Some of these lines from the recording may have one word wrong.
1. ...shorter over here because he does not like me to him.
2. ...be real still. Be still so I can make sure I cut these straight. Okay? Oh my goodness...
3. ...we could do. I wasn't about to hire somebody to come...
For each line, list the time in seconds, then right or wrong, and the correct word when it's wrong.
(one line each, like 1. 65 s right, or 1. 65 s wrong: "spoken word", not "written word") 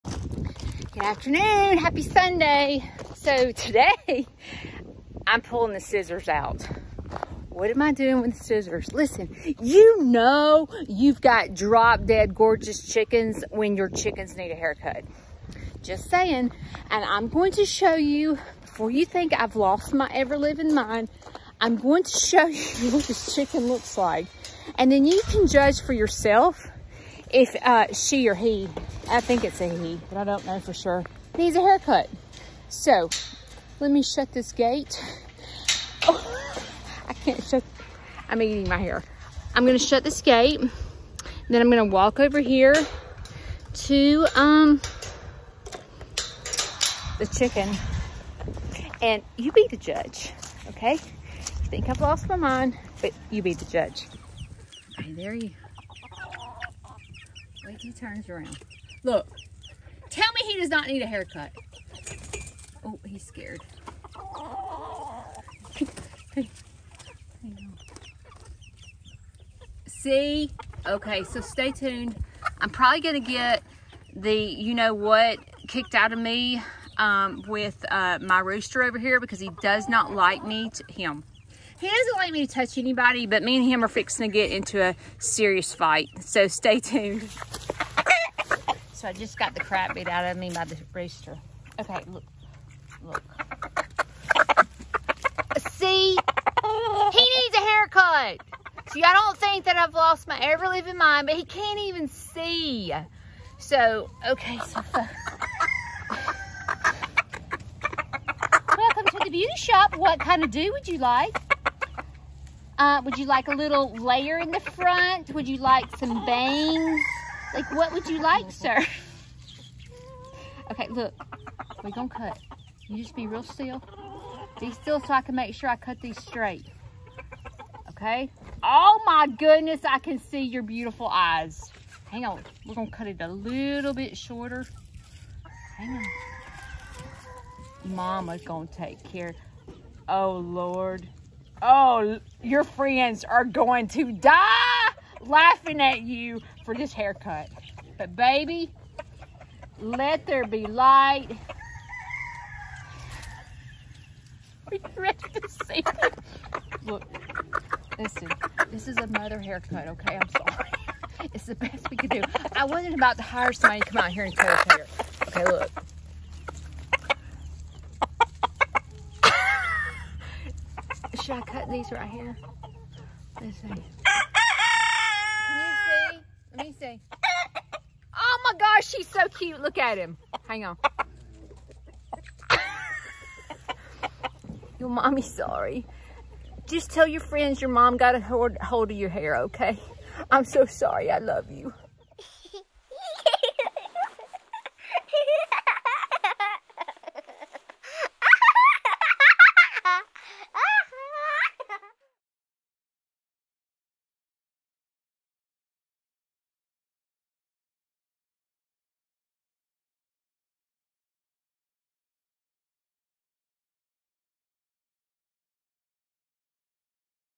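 1. 78 s wrong: "rooster", not "shorter"
2. 123 s right
3. 161 s right.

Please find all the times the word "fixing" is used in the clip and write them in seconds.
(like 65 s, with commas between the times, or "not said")
83 s.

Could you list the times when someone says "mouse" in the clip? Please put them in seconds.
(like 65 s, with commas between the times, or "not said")
not said.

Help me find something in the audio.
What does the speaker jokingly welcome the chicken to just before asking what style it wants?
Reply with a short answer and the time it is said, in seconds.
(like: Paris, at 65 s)
the beauty shop, at 109 s.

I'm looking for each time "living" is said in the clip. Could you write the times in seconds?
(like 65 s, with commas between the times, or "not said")
20 s, 100 s.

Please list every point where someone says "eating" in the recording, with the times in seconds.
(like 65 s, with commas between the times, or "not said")
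38 s.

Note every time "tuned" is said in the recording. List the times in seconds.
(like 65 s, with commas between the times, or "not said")
71 s, 86 s.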